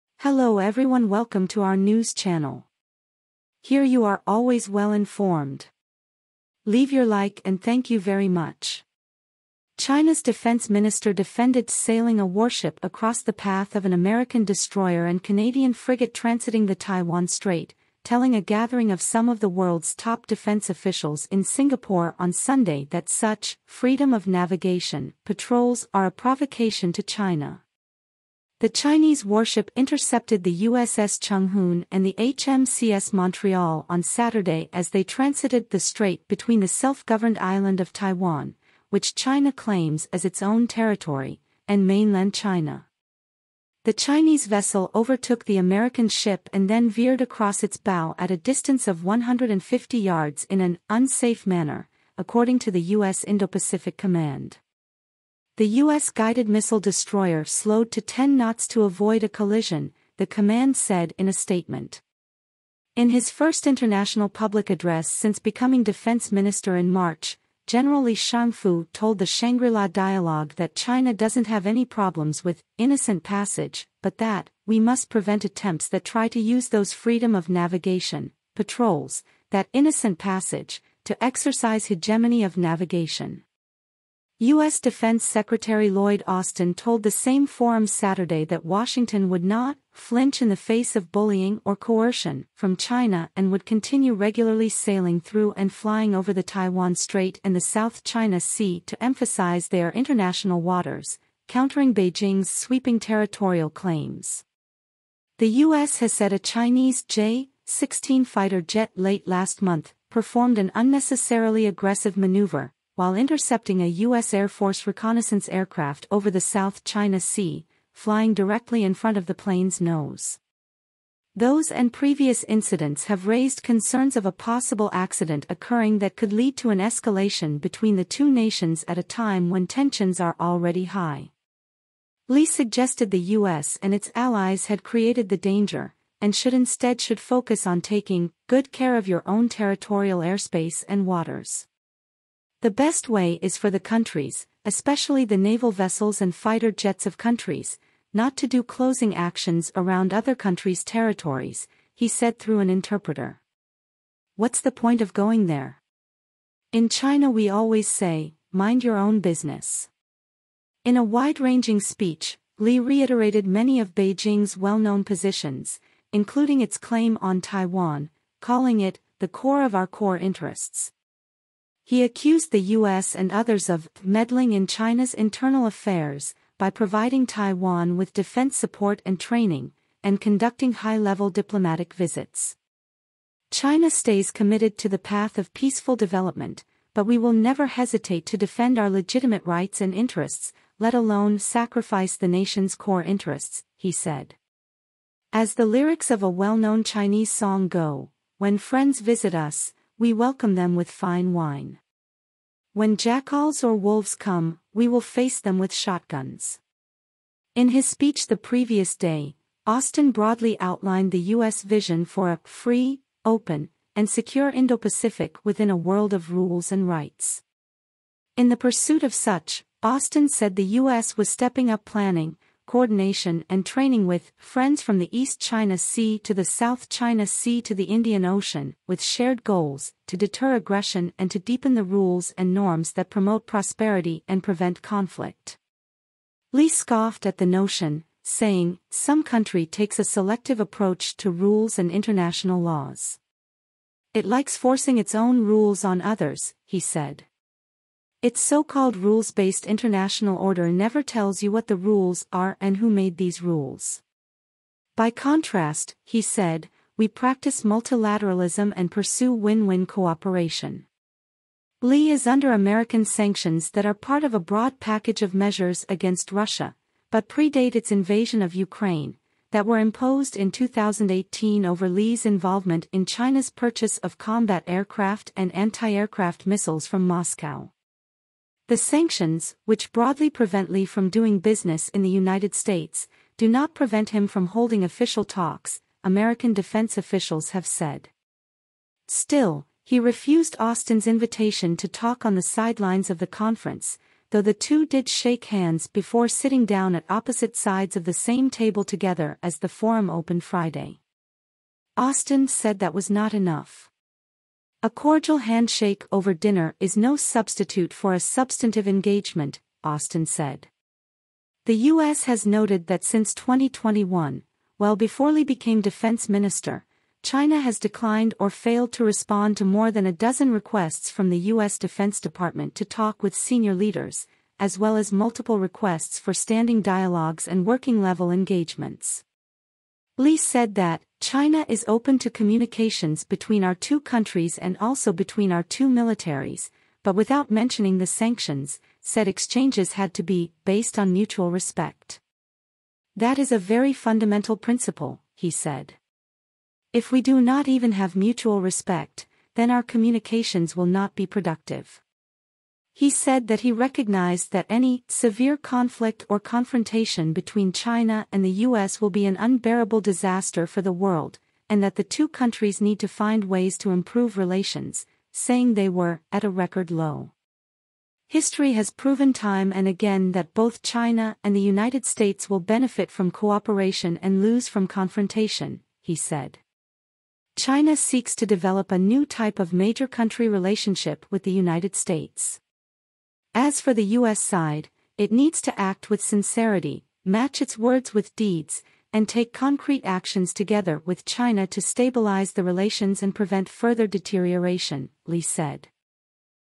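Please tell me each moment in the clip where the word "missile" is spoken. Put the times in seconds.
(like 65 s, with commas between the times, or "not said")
56 s, 276 s.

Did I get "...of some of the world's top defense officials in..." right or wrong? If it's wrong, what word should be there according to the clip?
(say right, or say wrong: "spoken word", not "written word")
right.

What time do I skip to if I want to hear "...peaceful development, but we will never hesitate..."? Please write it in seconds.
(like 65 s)
185 s.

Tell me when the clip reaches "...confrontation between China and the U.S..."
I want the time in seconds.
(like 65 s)
356 s.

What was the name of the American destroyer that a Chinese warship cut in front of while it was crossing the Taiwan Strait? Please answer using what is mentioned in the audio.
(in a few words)
USS Hoon.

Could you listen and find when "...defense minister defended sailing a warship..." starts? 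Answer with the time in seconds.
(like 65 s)
10 s.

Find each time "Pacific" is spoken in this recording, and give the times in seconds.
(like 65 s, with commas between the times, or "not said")
53 s, 214 s.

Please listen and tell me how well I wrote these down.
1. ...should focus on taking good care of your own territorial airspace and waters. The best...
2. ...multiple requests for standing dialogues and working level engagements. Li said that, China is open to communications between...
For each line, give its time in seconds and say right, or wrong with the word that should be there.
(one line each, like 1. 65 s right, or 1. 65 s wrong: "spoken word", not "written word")
1. 137 s right
2. 325 s right.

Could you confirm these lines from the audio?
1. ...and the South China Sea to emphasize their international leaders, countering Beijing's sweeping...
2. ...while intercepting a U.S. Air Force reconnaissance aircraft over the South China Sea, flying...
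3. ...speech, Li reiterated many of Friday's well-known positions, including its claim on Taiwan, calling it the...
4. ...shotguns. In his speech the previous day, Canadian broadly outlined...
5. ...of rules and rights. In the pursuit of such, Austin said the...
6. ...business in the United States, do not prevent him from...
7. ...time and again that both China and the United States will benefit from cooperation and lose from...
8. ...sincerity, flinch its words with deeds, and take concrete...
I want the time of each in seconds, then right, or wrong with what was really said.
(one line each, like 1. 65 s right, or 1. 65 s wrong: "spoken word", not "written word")
1. 97 s wrong: "waters", not "leaders"
2. 113 s right
3. 161 s wrong: "Beijing", not "Friday"
4. 205 s wrong: "Austin", not "Canadian"
5. 216 s right
6. 281 s right
7. 369 s right
8. 386 s wrong: "match", not "flinch".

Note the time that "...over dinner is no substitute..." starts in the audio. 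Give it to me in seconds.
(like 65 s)
306 s.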